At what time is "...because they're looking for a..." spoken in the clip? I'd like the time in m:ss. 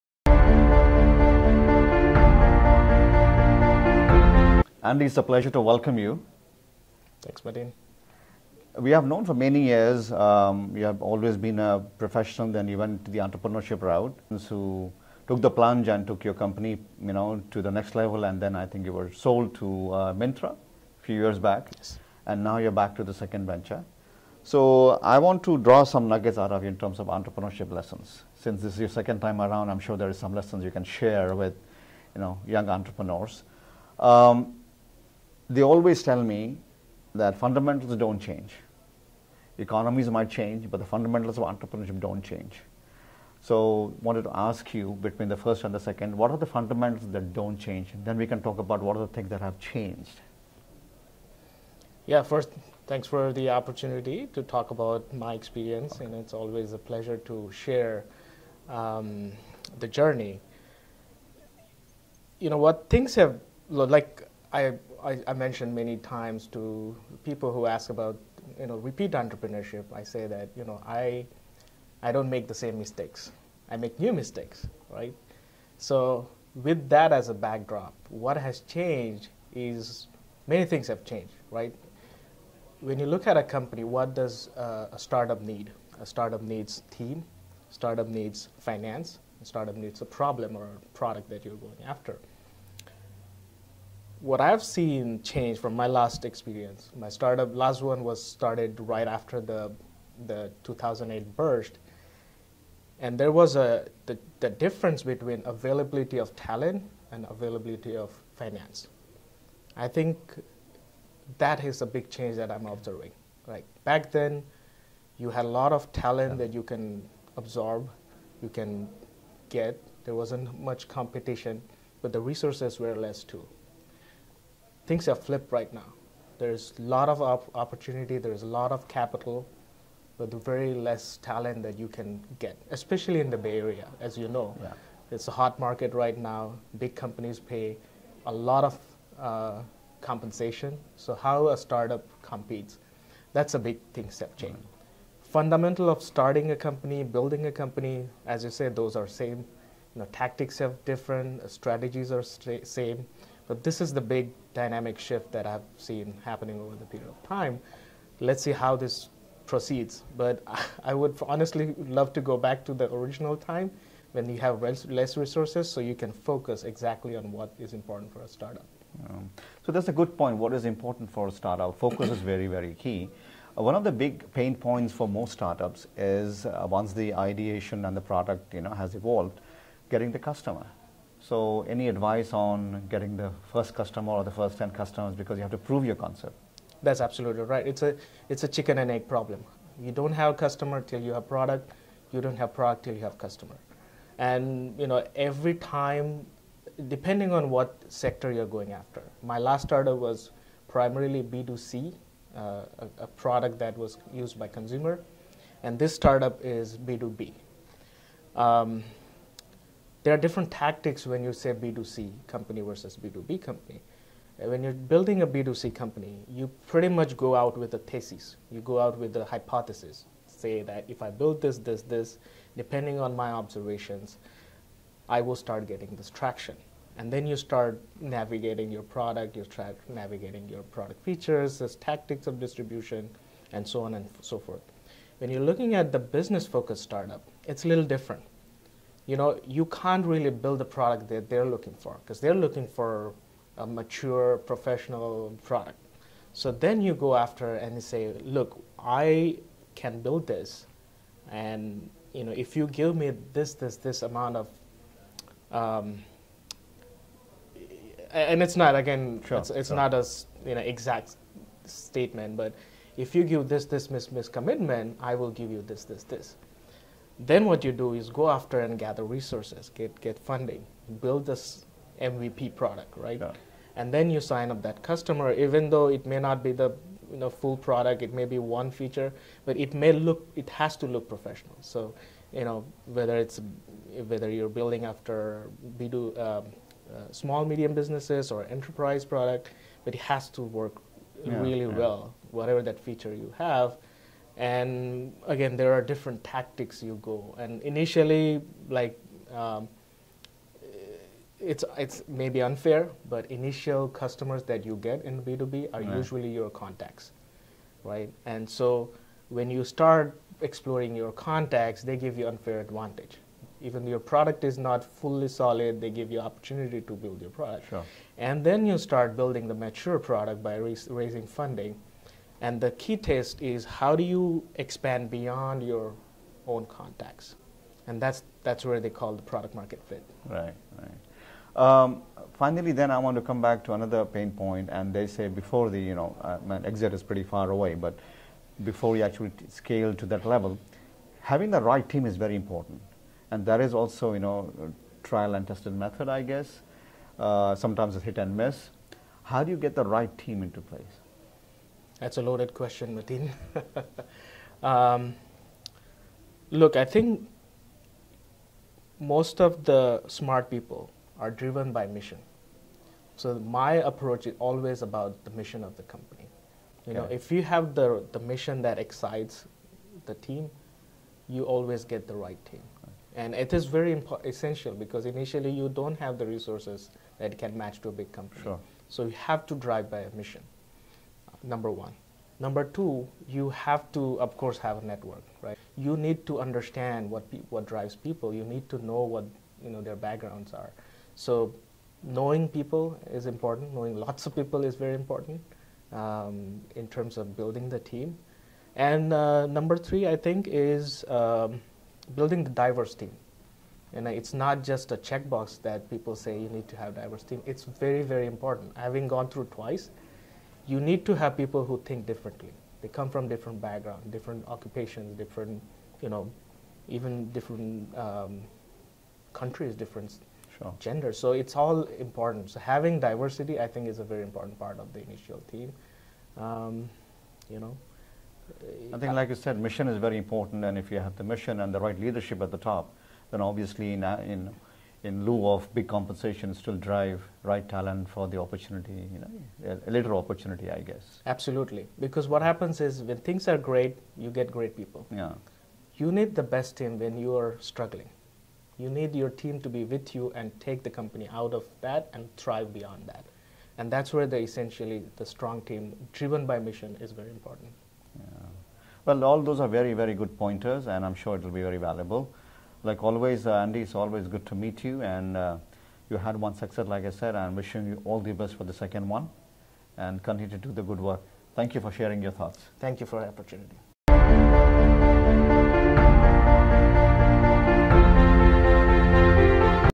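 4:02.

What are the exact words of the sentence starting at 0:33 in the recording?
Um, they always tell me that fundamentals don't change.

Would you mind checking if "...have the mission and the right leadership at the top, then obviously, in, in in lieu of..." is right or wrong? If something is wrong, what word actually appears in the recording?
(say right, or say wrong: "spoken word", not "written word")
right.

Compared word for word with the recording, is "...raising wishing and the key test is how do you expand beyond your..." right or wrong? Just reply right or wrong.
wrong.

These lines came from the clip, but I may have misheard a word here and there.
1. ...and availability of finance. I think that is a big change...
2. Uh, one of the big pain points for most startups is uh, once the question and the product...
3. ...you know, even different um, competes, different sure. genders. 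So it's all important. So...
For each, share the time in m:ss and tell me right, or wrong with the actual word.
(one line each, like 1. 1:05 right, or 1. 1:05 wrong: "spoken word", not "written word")
1. 1:47 right
2. 2:53 wrong: "ideation", not "question"
3. 6:56 wrong: "countries", not "competes".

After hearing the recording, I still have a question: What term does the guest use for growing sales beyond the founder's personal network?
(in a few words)
product market fit.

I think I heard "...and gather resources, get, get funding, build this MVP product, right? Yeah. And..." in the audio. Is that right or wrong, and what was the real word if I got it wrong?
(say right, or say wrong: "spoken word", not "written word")
right.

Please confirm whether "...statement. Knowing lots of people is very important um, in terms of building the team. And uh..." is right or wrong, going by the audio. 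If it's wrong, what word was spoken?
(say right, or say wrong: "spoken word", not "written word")
wrong: "important", not "statement".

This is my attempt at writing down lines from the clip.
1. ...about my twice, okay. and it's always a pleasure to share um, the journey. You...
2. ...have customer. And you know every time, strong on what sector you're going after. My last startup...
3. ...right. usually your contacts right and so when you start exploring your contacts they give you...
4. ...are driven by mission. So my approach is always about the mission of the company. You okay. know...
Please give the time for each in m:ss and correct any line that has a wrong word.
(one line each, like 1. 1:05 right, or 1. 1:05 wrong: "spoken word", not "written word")
1. 0:54 wrong: "experience", not "twice"
2. 3:13 wrong: "depending", not "strong"
3. 5:05 right
4. 6:01 right.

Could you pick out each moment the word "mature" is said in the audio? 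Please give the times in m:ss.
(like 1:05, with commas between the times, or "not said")
4:03, 5:19.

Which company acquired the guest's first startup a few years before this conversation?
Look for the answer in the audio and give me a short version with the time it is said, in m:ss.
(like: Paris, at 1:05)
Myntra, at 0:20.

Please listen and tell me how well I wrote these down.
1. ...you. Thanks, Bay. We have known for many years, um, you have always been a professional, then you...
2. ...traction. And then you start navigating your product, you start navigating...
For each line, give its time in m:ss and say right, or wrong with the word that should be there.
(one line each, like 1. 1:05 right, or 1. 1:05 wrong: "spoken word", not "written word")
1. 0:05 wrong: "Mateen", not "Bay"
2. 3:46 right.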